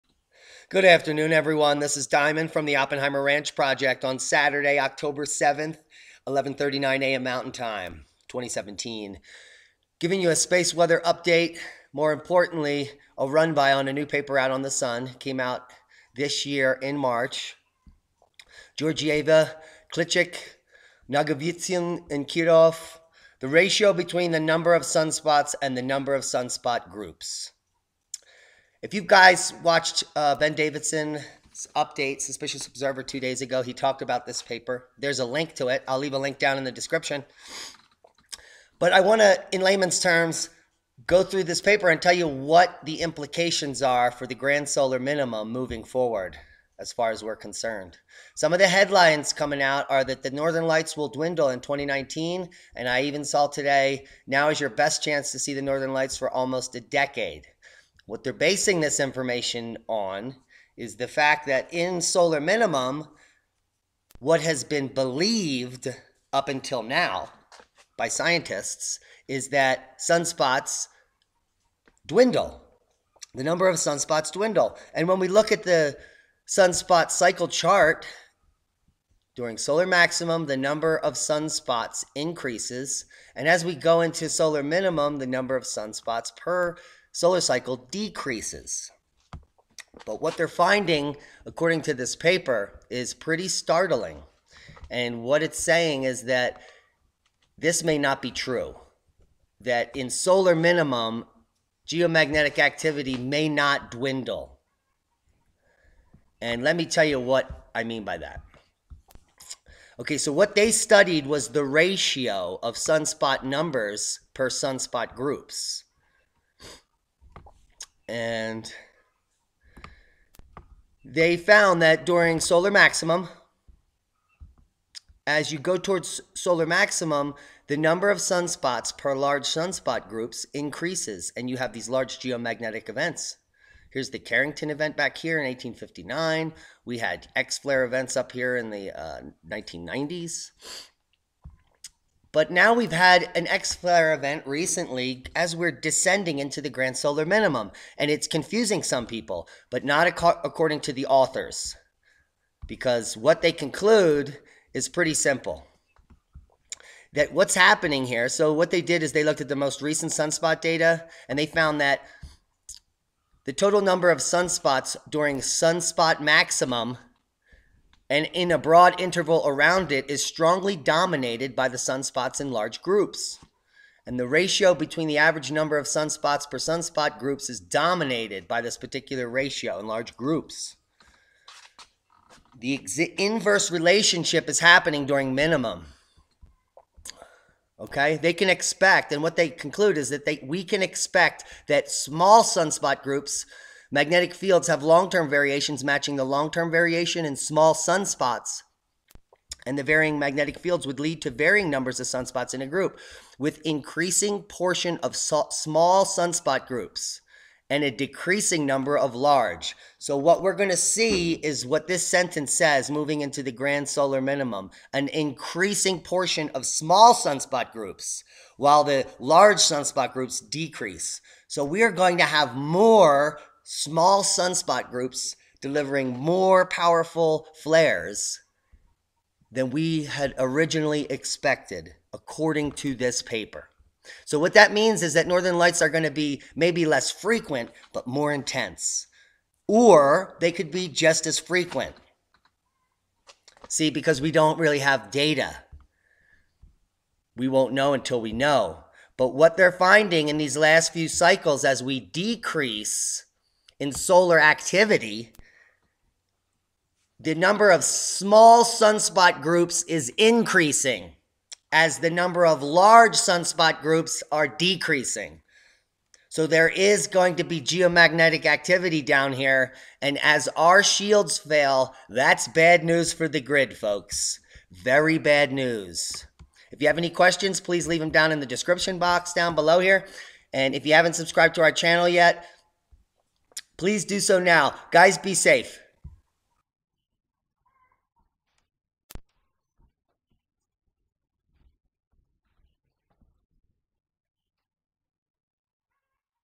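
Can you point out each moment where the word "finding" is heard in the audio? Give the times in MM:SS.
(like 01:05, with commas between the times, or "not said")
01:30, 04:09.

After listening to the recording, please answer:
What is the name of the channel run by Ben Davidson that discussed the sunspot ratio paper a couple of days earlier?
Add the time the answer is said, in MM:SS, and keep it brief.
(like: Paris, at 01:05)
Suspicious Observer, at 00:32.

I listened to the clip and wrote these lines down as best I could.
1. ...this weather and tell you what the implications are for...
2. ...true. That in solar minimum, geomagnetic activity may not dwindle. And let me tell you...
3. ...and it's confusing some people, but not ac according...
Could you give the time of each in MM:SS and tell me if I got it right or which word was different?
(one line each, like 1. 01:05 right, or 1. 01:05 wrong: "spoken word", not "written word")
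1. 00:41 wrong: "paper", not "weather"
2. 01:38 right
3. 02:27 right.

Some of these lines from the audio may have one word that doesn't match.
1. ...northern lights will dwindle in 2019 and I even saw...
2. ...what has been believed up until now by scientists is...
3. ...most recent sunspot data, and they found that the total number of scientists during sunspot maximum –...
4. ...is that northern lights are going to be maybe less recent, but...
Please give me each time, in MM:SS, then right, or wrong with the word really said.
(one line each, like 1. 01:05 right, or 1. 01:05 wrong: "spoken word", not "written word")
1. 00:50 right
2. 01:04 right
3. 02:39 wrong: "sunspots", not "scientists"
4. 03:55 wrong: "frequent", not "recent".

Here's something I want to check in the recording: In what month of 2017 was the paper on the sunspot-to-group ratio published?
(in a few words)
March.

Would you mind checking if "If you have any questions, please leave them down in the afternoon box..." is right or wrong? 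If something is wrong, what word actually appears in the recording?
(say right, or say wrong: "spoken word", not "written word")
wrong: "description", not "afternoon".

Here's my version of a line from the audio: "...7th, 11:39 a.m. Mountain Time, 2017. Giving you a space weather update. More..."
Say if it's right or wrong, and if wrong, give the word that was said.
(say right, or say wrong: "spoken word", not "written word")
right.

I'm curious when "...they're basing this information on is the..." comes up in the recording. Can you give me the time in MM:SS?
00:58.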